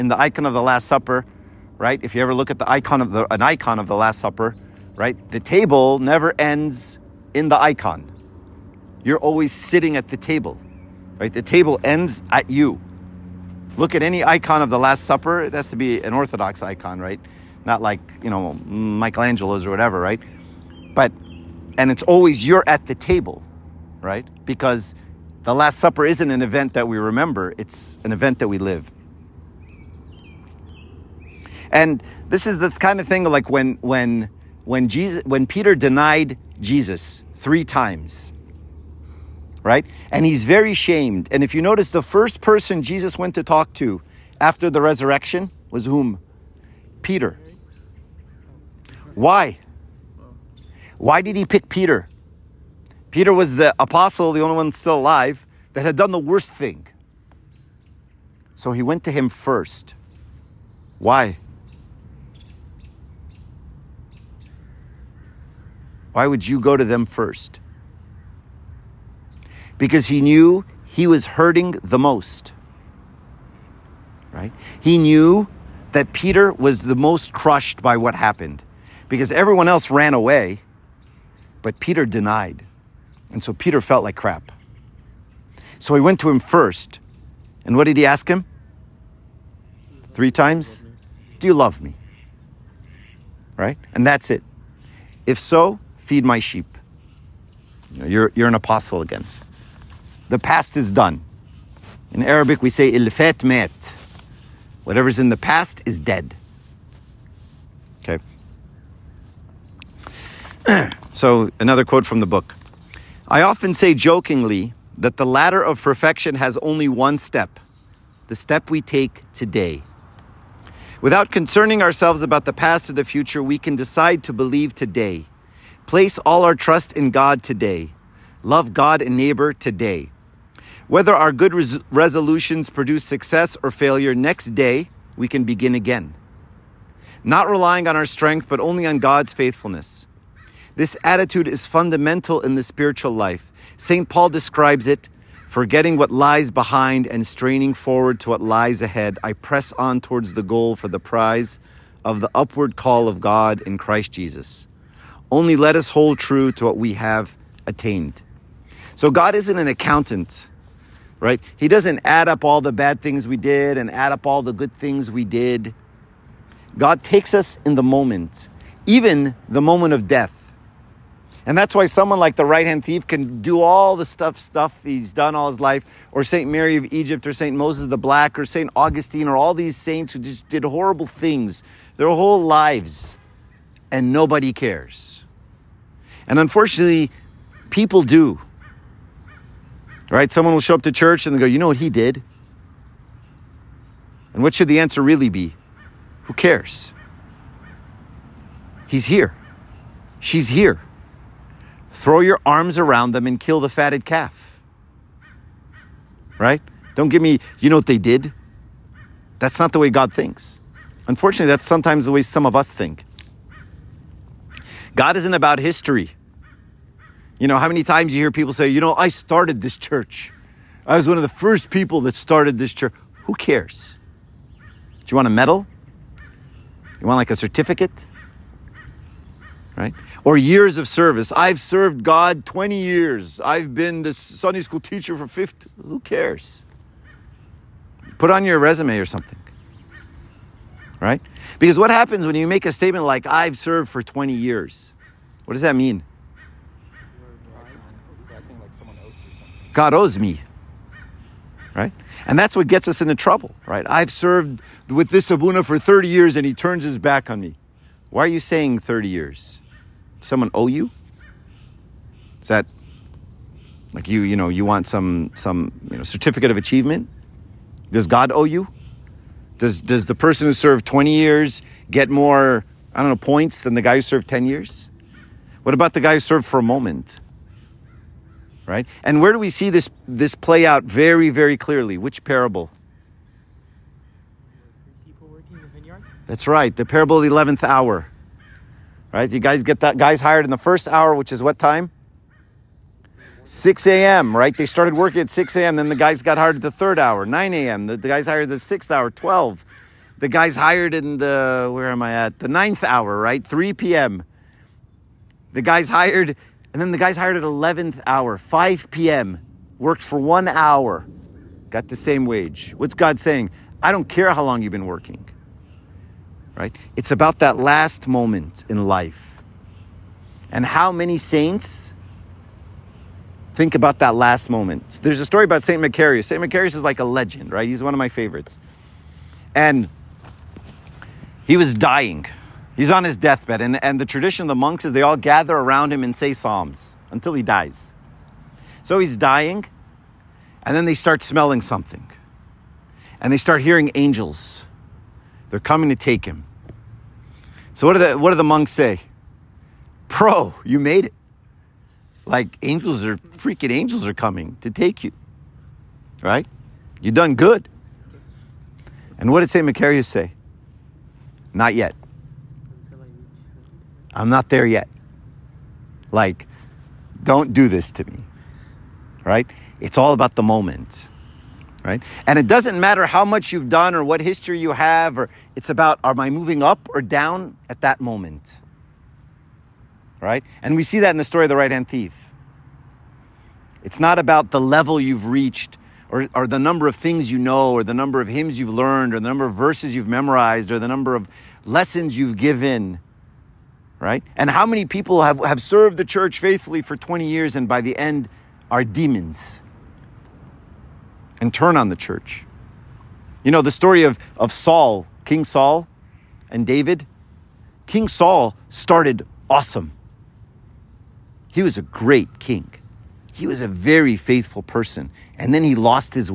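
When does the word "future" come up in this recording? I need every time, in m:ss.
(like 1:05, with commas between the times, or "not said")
2:03.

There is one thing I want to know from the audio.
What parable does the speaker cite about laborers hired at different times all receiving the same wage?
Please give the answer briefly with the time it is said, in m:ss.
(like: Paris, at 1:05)
the parable of the 11th hour, at 4:46.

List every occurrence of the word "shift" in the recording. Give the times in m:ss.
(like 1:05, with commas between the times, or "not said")
not said.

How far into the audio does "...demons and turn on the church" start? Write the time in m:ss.
6:38.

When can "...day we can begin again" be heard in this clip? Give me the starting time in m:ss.
2:14.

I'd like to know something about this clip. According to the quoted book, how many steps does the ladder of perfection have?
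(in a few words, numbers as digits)
1.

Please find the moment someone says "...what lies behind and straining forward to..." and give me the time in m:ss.
2:25.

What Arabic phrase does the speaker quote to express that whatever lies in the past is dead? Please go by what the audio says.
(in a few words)
ilfat met.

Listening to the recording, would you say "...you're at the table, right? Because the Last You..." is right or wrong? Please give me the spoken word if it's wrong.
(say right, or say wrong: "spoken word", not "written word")
wrong: "Supper", not "You".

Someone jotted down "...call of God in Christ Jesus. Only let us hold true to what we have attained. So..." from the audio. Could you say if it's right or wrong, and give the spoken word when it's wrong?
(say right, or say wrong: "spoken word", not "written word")
right.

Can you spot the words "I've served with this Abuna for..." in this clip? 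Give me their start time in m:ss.
4:13.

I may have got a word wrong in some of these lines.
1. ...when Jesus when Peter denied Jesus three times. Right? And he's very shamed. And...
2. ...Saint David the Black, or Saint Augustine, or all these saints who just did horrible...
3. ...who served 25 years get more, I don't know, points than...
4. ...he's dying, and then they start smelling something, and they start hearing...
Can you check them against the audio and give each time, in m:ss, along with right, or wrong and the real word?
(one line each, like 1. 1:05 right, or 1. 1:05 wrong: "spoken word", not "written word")
1. 0:34 right
2. 2:57 wrong: "Moses", not "David"
3. 4:30 wrong: "20", not "25"
4. 5:38 right.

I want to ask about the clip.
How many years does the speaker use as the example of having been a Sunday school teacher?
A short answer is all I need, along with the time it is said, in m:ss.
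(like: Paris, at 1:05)
50, at 3:55.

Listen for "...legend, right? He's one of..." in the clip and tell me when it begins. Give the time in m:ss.
5:27.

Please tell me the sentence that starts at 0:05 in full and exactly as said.
The table never ends in the icon.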